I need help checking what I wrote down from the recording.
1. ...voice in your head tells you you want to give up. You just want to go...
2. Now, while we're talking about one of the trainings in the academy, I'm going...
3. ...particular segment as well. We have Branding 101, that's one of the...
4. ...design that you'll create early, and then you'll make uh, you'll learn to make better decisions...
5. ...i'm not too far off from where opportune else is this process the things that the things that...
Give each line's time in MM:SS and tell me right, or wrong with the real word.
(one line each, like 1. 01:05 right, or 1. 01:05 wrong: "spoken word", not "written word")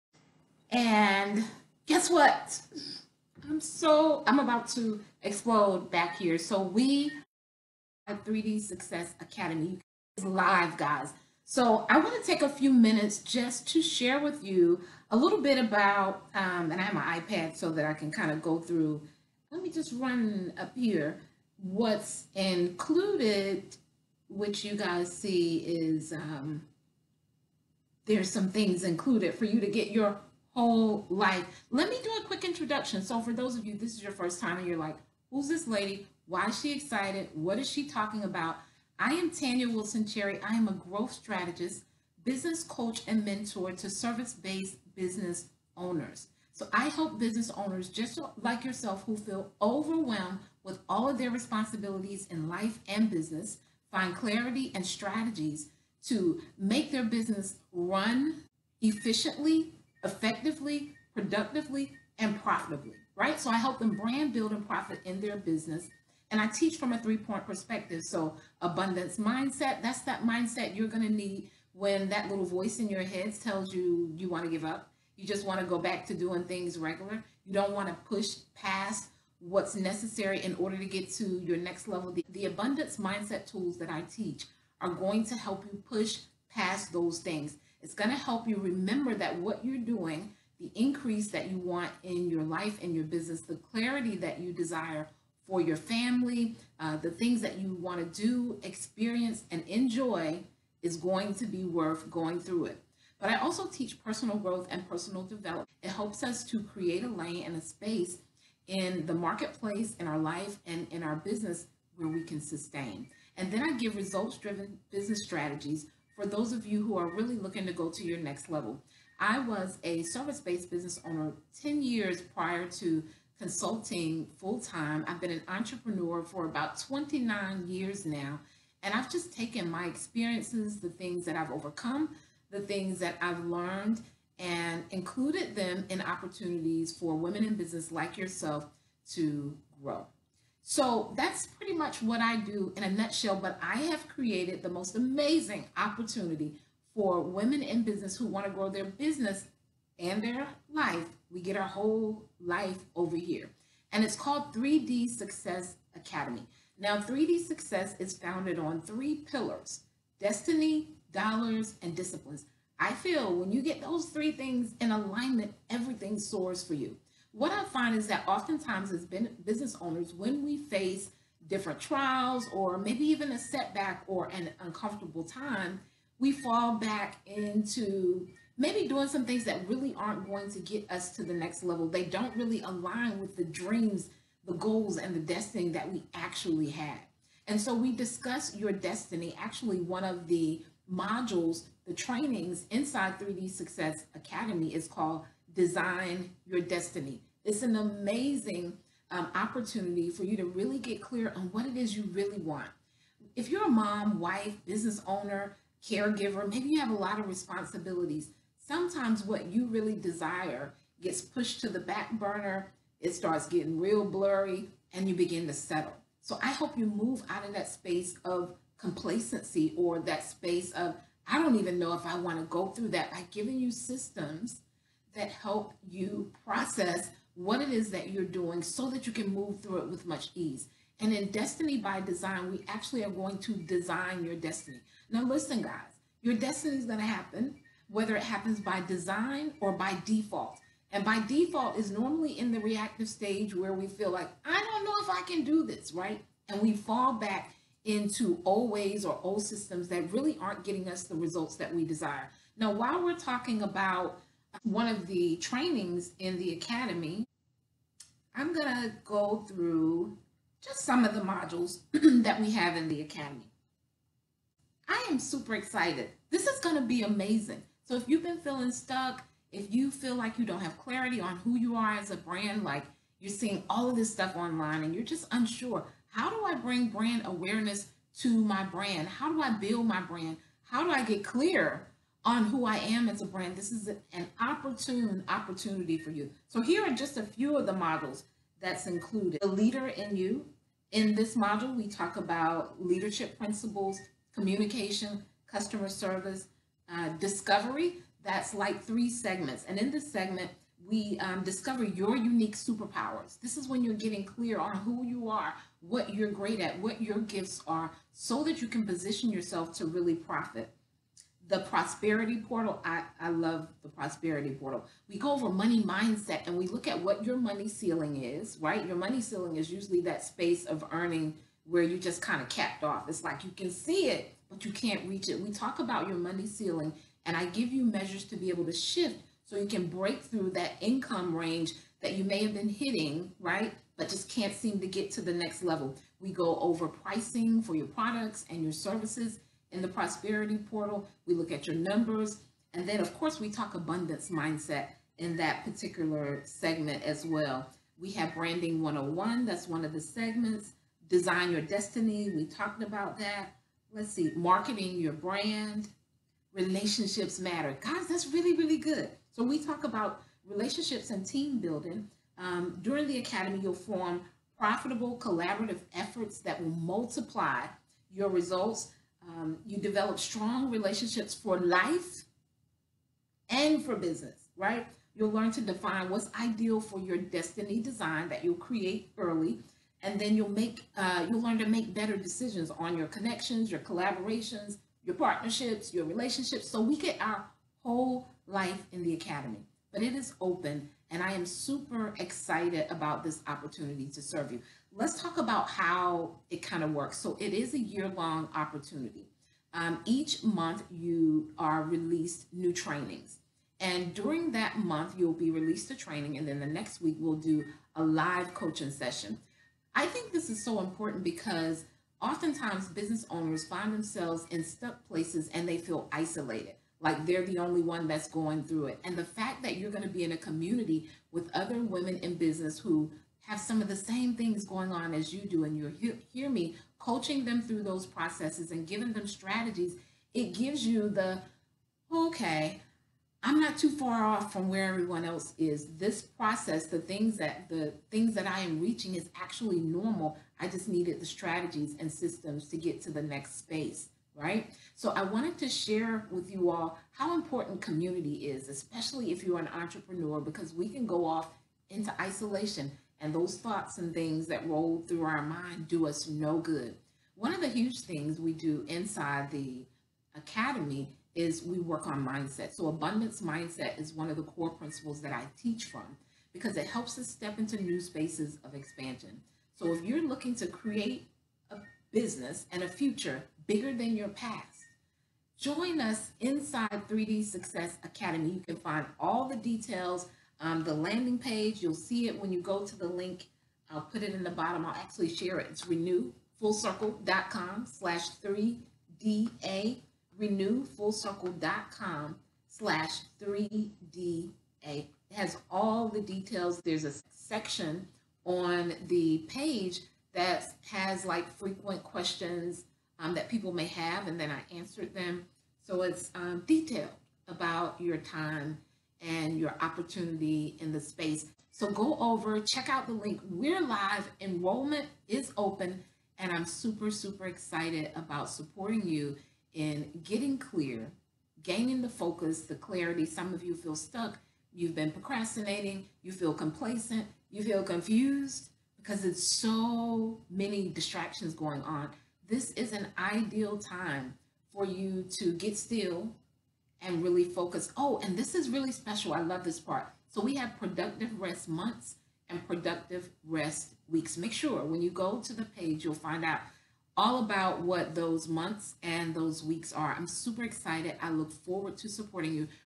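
1. 01:12 right
2. 04:12 right
3. 05:45 right
4. 06:17 right
5. 07:13 wrong: "everyone", not "opportune".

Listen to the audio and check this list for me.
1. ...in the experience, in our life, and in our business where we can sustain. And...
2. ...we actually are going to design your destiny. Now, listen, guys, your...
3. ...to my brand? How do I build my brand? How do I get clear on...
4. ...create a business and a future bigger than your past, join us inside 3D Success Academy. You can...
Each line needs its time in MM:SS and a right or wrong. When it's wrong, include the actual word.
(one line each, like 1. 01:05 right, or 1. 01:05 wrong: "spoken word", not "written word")
1. 01:48 wrong: "marketplace", not "experience"
2. 03:52 right
3. 04:38 right
4. 07:50 right.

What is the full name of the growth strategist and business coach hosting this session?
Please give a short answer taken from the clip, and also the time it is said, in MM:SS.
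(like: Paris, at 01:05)
Tanya Wilson Cherry, at 00:39.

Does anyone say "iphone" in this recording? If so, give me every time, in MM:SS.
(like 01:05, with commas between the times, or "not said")
not said.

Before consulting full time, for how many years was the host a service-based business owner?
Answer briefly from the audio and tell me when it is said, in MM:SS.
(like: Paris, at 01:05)
10, at 02:01.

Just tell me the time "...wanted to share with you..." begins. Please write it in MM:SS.
07:25.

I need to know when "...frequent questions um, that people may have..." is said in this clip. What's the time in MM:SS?
08:21.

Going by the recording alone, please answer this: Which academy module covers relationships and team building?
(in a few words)
Relationships matter.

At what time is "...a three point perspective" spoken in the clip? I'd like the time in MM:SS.
01:06.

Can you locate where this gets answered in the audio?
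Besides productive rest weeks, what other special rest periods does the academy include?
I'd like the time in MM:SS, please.
09:00.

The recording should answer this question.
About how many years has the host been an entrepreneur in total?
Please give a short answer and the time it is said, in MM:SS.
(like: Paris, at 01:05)
29, at 02:06.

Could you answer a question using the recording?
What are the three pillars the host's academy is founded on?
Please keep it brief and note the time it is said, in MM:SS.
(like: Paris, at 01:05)
destiny, dollars, and disciplines, at 02:40.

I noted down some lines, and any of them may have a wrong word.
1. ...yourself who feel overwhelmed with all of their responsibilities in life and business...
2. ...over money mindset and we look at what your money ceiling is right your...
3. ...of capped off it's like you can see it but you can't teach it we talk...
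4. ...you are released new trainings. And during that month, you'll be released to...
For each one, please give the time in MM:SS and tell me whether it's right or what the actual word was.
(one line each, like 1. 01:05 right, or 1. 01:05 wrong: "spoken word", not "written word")
1. 00:48 right
2. 05:15 right
3. 05:22 wrong: "reach", not "teach"
4. 06:40 right.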